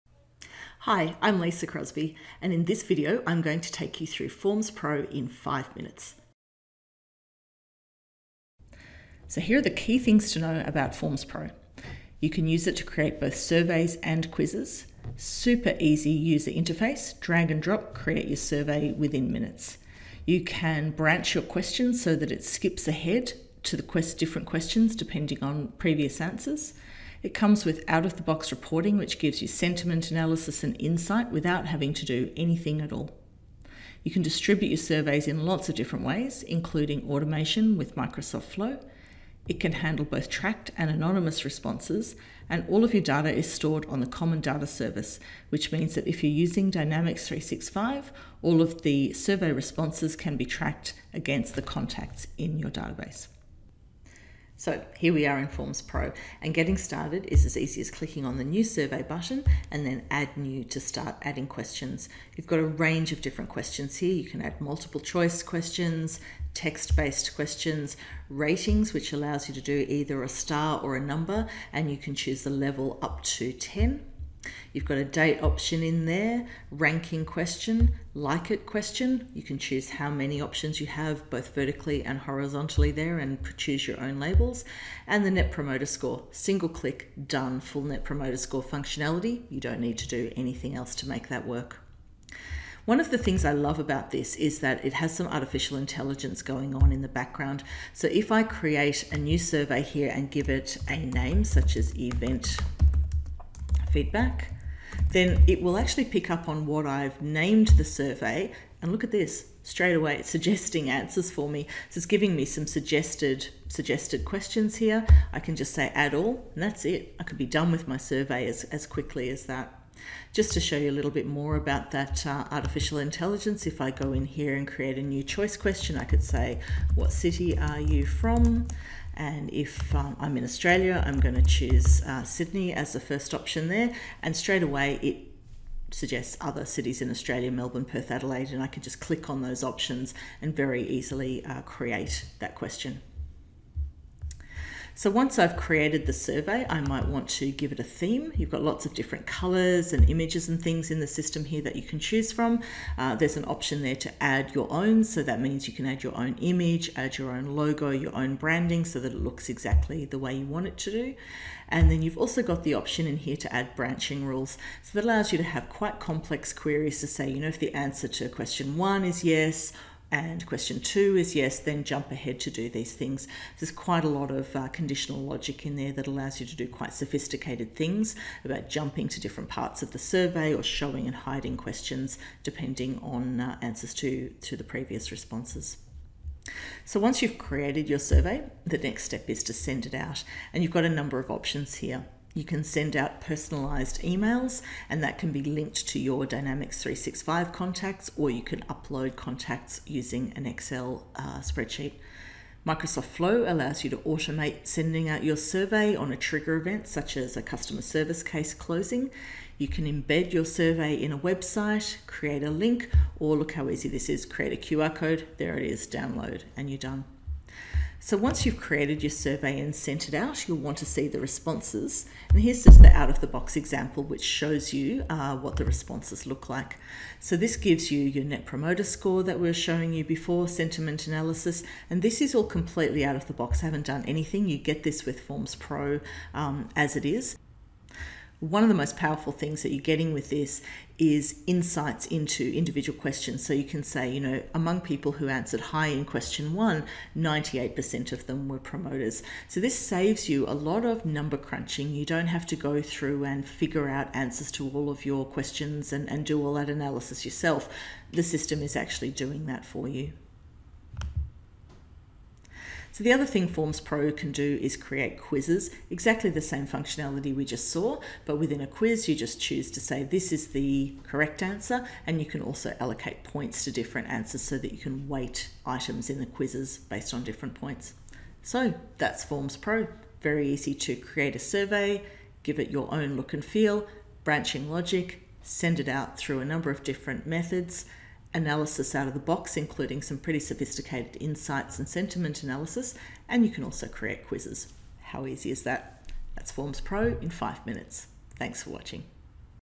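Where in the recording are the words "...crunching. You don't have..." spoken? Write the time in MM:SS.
04:11.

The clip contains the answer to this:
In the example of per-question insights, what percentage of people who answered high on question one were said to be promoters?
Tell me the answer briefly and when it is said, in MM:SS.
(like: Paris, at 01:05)
98%, at 04:07.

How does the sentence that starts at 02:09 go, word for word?
And if um, I'm in Australia, I'm going to choose uh, Sydney as the first option there.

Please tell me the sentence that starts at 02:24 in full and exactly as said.
So once I've created the survey, I might want to give it a theme.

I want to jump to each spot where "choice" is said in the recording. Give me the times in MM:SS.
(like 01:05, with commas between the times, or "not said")
01:05, 02:05.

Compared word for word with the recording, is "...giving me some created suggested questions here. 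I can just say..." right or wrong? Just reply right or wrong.
wrong.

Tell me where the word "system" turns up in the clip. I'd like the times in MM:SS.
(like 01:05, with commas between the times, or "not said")
02:31, 04:18.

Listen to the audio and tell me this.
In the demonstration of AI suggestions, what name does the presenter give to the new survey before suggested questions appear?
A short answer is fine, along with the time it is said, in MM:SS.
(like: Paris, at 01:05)
Event feedback, at 01:41.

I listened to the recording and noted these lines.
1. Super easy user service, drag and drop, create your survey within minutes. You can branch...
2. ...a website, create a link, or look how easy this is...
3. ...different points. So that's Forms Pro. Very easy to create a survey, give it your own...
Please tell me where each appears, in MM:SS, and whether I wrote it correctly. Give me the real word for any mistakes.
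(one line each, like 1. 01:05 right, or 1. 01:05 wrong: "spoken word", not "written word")
1. 00:15 wrong: "interface", not "service"
2. 03:31 right
3. 04:37 right.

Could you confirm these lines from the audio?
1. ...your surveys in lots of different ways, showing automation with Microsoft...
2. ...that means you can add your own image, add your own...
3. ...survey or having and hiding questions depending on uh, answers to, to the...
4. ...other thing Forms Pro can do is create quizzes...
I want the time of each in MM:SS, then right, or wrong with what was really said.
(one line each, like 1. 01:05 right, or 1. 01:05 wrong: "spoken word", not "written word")
1. 00:34 wrong: "including", not "showing"
2. 02:35 right
3. 02:59 wrong: "showing", not "having"
4. 04:23 right.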